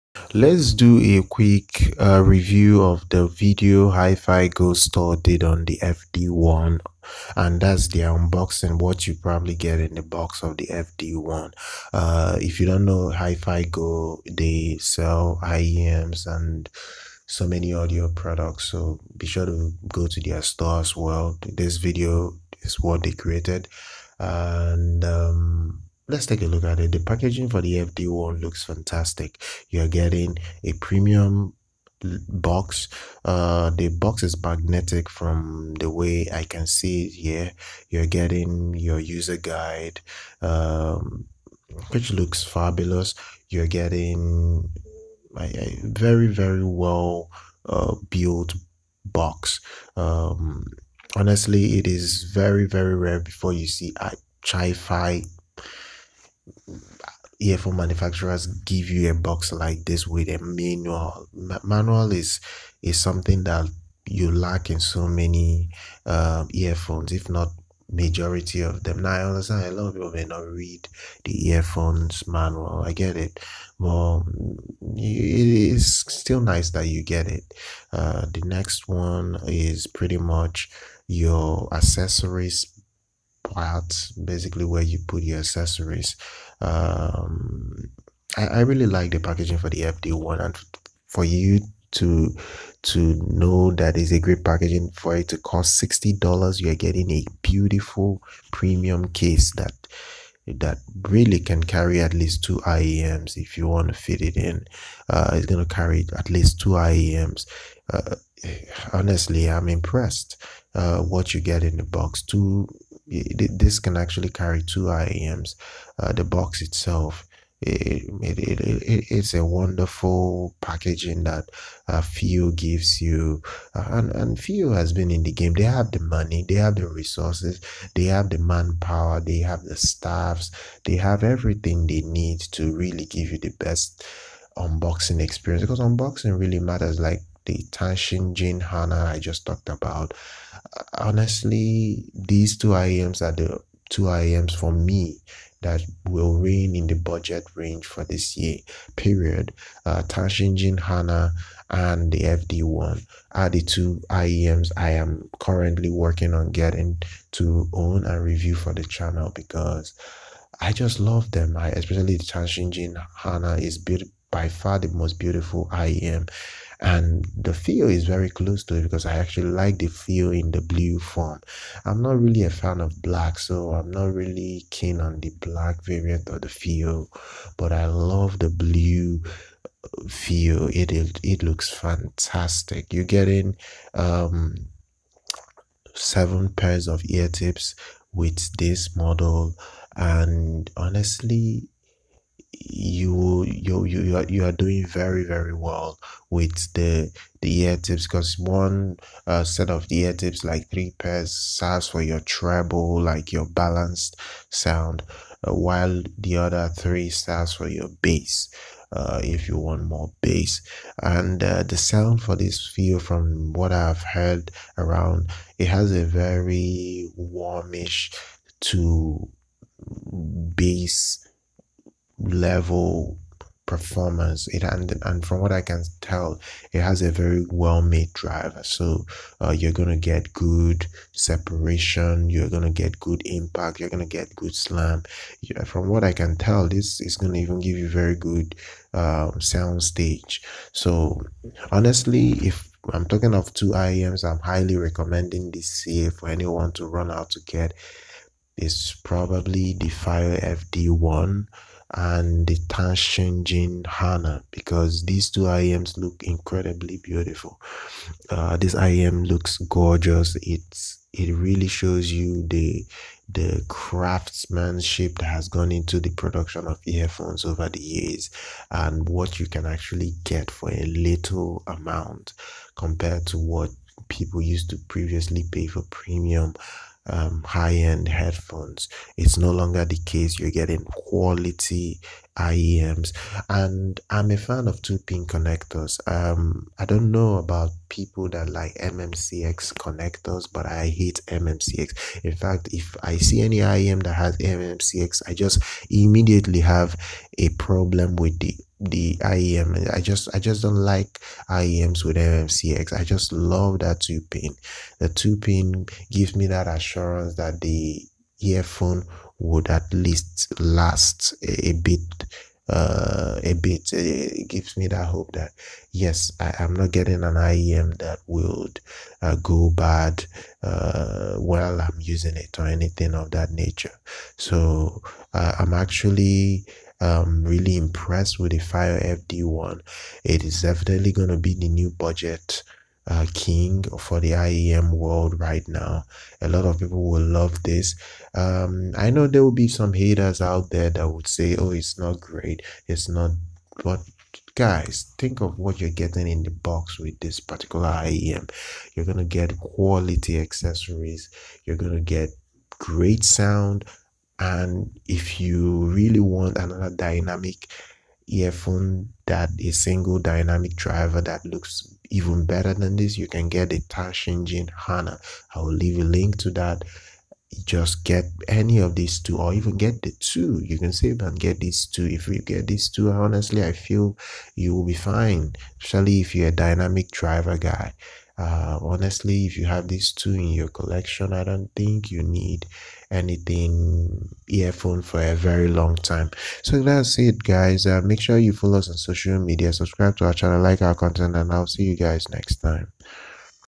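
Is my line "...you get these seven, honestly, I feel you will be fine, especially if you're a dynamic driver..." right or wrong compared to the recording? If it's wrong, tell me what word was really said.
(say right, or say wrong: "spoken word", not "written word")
wrong: "two", not "seven".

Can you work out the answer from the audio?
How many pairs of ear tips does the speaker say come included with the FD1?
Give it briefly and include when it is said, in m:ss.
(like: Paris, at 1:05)
7, at 3:05.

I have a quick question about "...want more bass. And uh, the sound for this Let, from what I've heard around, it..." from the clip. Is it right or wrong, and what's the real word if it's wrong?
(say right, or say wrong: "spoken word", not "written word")
wrong: "Fiio", not "Let".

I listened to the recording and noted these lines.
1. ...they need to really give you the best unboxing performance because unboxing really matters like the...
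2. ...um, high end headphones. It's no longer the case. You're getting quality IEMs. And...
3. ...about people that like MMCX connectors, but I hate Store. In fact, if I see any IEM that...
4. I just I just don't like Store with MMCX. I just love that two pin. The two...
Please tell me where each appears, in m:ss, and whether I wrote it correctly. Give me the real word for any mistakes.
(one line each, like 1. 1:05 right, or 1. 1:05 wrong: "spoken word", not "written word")
1. 2:11 wrong: "experience", not "performance"
2. 4:37 right
3. 4:47 wrong: "MMCX", not "Store"
4. 4:59 wrong: "IEMs", not "Store".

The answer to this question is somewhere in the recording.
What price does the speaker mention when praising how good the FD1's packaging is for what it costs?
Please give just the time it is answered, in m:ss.
1:35.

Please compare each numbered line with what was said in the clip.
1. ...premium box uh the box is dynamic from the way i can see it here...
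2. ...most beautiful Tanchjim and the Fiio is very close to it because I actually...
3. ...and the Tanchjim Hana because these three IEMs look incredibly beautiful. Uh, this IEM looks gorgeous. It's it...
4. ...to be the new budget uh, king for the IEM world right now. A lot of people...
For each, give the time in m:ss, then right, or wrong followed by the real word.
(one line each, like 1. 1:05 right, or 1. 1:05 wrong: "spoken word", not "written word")
1. 0:30 wrong: "magnetic", not "dynamic"
2. 2:44 wrong: "IEM", not "Tanchjim"
3. 4:11 wrong: "two", not "three"
4. 5:31 right.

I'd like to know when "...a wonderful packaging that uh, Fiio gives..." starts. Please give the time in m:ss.
1:59.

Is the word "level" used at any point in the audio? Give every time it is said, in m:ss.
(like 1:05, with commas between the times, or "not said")
3:42.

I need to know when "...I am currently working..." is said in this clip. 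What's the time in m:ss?
2:34.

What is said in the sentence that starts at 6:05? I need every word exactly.
I will leave a link to that.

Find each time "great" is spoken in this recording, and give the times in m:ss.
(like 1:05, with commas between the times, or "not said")
1:34, 5:42, 5:52.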